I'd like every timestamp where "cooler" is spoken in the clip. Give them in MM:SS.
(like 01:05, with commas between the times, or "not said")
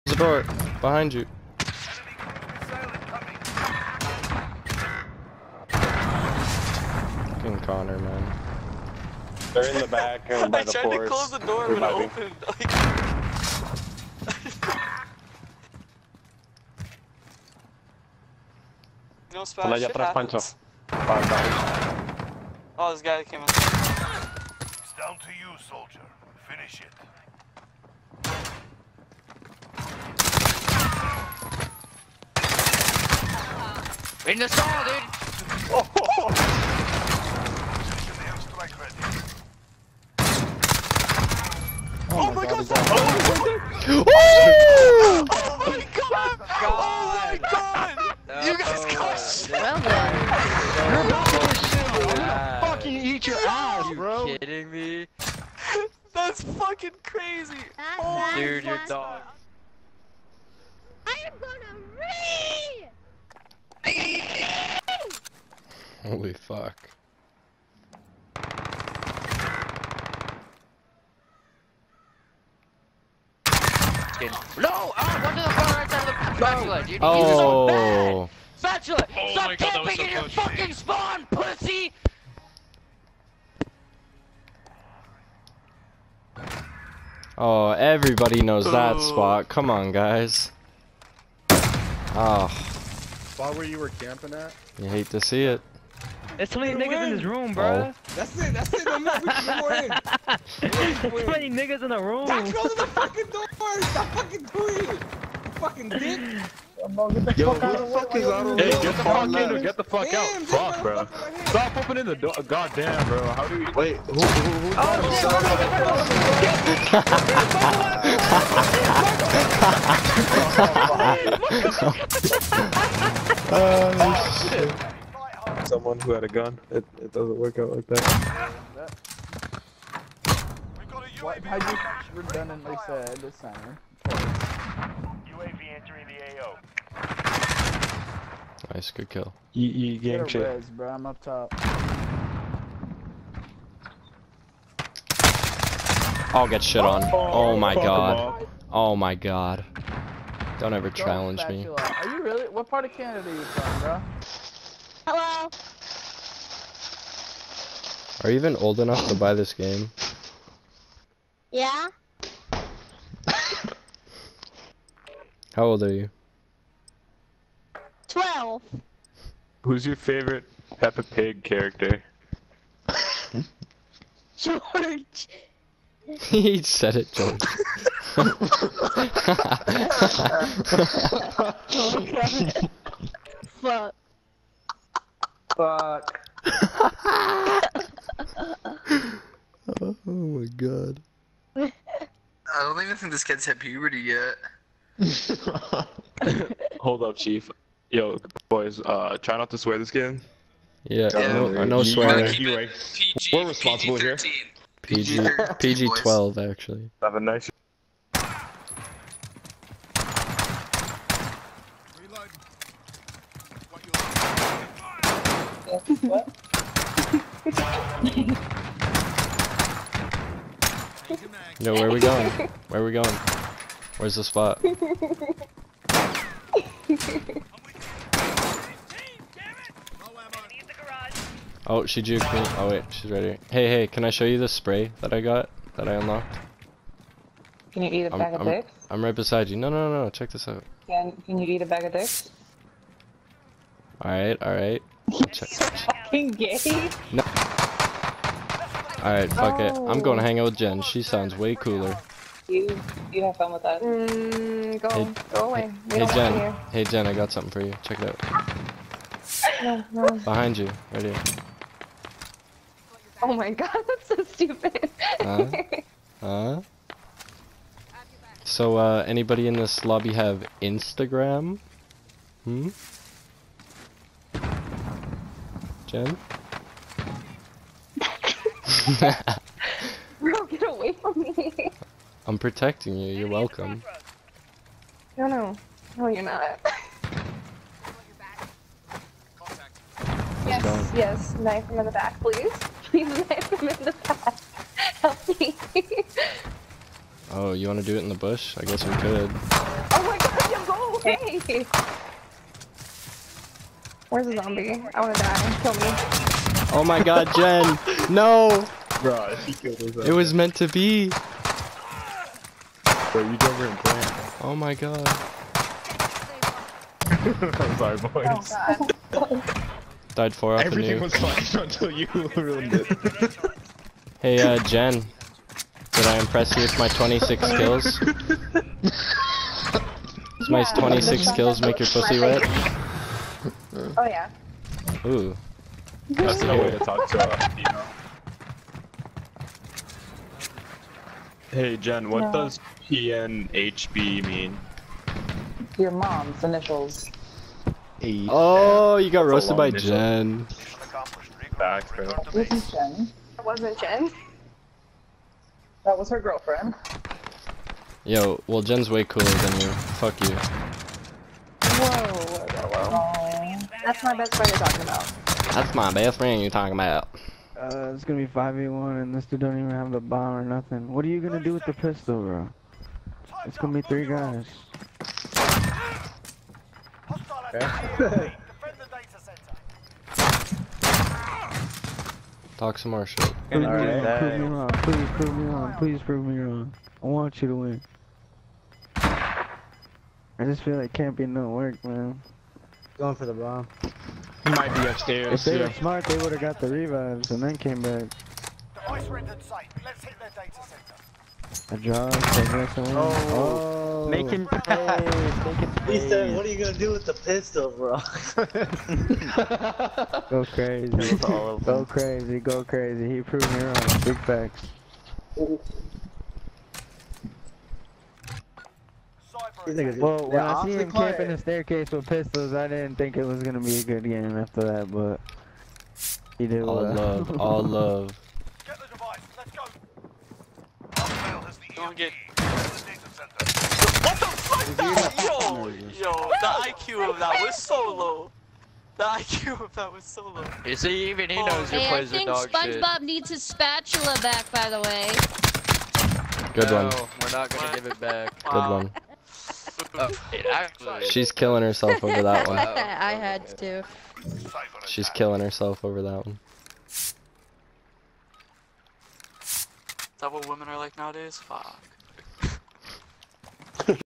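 04:11, 05:59.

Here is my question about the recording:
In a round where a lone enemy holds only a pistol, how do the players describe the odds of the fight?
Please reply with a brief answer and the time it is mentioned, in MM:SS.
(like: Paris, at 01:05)
5v1, at 06:08.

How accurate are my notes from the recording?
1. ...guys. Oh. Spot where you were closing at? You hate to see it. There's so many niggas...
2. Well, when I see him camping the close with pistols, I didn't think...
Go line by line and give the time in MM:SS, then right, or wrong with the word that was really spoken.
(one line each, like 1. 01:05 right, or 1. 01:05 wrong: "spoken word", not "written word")
1. 01:29 wrong: "camping", not "closing"
2. 06:59 wrong: "staircase", not "close".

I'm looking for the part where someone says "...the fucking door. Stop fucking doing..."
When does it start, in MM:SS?
01:42.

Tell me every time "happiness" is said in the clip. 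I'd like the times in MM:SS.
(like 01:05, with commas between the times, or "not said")
not said.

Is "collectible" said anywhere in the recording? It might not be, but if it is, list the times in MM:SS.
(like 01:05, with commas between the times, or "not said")
not said.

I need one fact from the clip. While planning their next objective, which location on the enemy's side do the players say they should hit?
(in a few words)
Data center.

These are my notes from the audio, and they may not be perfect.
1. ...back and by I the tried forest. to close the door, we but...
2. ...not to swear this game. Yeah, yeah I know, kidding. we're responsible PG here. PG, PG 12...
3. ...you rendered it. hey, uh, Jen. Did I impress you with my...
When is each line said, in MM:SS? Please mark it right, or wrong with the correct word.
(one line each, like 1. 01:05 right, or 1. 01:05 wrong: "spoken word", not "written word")
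1. 00:09 right
2. 03:19 wrong: "swearing", not "kidding"
3. 05:21 wrong: "ruined", not "rendered".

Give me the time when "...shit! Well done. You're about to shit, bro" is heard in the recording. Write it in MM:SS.
00:49.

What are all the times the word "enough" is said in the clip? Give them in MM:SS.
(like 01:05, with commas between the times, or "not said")
02:38.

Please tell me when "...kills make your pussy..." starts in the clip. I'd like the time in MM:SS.
05:31.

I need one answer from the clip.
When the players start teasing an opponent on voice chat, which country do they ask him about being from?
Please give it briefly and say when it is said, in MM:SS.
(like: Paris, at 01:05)
Canada, at 02:32.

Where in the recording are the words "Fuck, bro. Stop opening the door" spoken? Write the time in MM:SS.
01:50.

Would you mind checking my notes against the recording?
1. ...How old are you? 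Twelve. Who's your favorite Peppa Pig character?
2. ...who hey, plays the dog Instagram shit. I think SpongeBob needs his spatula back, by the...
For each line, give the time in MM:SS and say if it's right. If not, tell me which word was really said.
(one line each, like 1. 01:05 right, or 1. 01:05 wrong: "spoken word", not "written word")
1. 02:45 right
2. 07:21 wrong: "SpongeBob", not "Instagram".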